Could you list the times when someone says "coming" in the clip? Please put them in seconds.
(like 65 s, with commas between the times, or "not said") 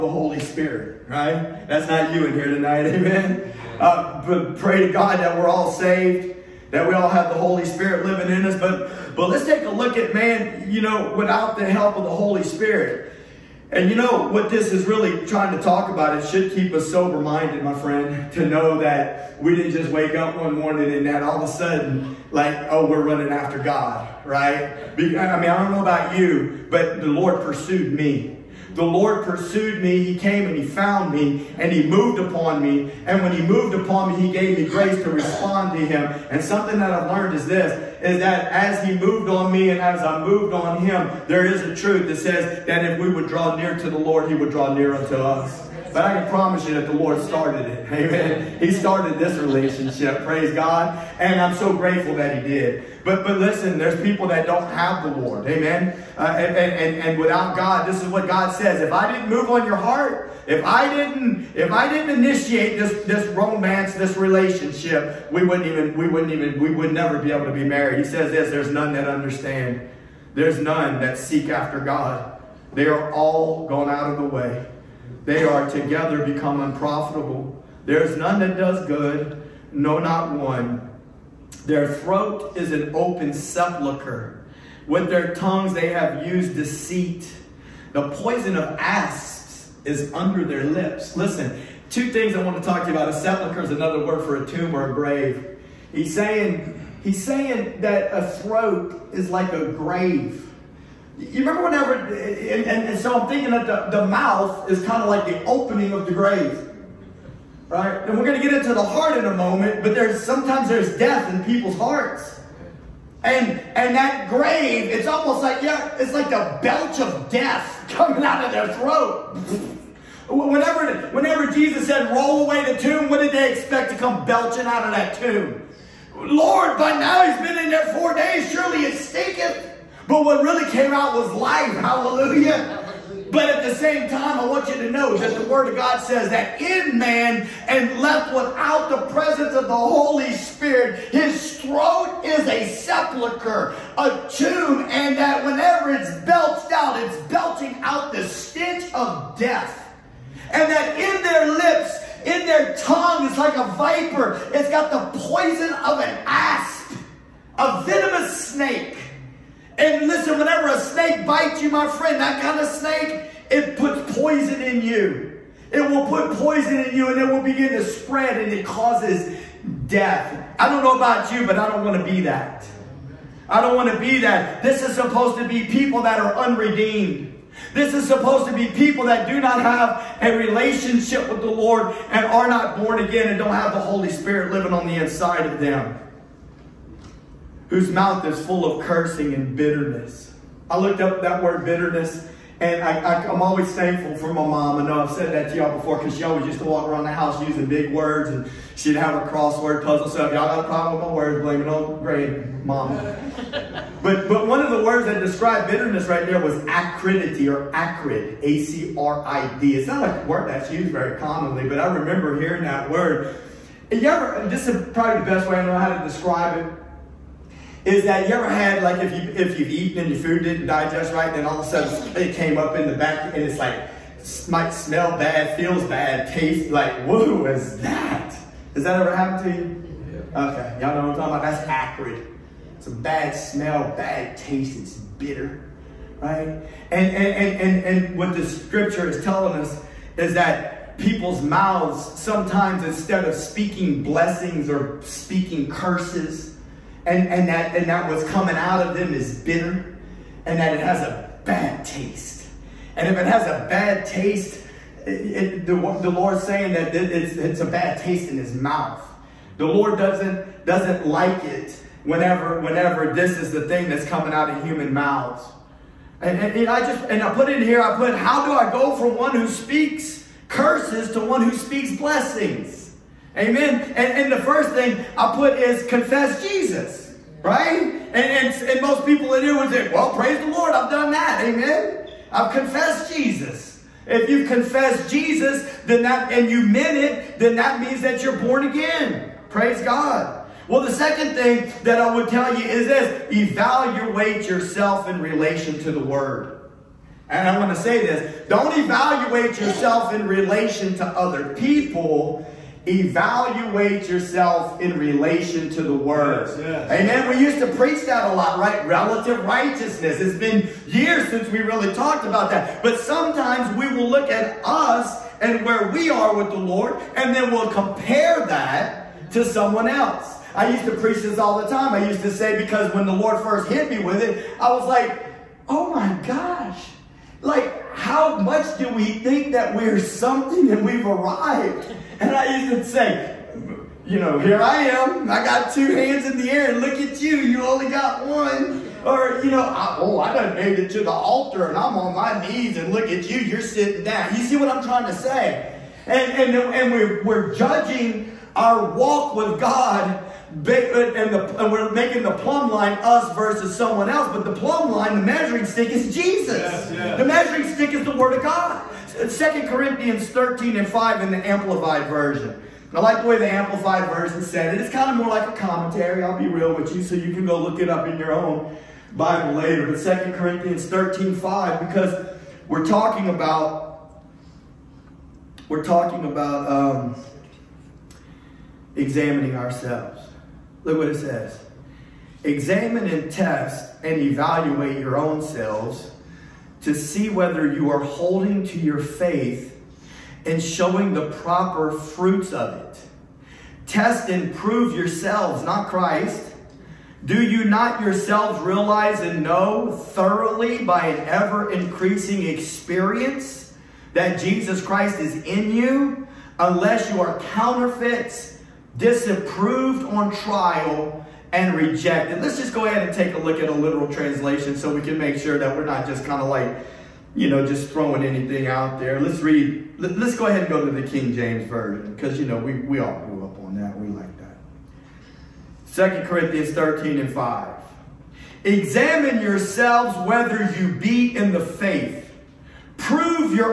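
117 s, 248 s, 264 s.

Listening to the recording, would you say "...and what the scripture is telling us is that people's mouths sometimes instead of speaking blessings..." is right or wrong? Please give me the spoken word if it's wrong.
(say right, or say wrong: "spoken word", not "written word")
right.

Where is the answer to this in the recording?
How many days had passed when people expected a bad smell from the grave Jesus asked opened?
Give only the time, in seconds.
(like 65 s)
127 s.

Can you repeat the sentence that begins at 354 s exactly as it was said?
But the plumb line, the measuring stick, is Jesus.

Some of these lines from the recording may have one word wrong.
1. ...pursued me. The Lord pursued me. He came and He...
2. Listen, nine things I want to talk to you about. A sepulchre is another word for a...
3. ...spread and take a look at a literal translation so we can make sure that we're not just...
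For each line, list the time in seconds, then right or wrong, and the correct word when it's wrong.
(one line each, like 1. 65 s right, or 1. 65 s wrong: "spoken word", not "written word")
1. 27 s right
2. 91 s wrong: "two", not "nine"
3. 412 s wrong: "ahead", not "spread".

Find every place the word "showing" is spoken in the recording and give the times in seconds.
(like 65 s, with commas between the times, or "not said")
390 s.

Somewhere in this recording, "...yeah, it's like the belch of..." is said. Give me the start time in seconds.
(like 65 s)
115 s.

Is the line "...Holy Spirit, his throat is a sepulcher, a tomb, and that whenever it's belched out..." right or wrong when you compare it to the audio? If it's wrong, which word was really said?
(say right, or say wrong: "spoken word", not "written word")
right.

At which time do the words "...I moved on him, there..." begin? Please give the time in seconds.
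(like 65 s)
40 s.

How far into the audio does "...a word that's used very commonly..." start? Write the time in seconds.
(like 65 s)
210 s.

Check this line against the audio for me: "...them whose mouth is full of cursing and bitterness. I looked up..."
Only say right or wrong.
right.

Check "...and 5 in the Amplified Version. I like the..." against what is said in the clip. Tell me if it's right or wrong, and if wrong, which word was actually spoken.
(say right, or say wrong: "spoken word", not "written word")
right.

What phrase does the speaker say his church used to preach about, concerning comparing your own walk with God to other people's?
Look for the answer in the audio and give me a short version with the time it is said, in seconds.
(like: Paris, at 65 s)
relative righteousness, at 308 s.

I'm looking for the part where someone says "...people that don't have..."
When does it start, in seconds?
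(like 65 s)
54 s.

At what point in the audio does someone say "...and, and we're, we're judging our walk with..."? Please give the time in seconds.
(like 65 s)
346 s.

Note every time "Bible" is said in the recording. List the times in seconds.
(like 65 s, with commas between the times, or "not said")
369 s.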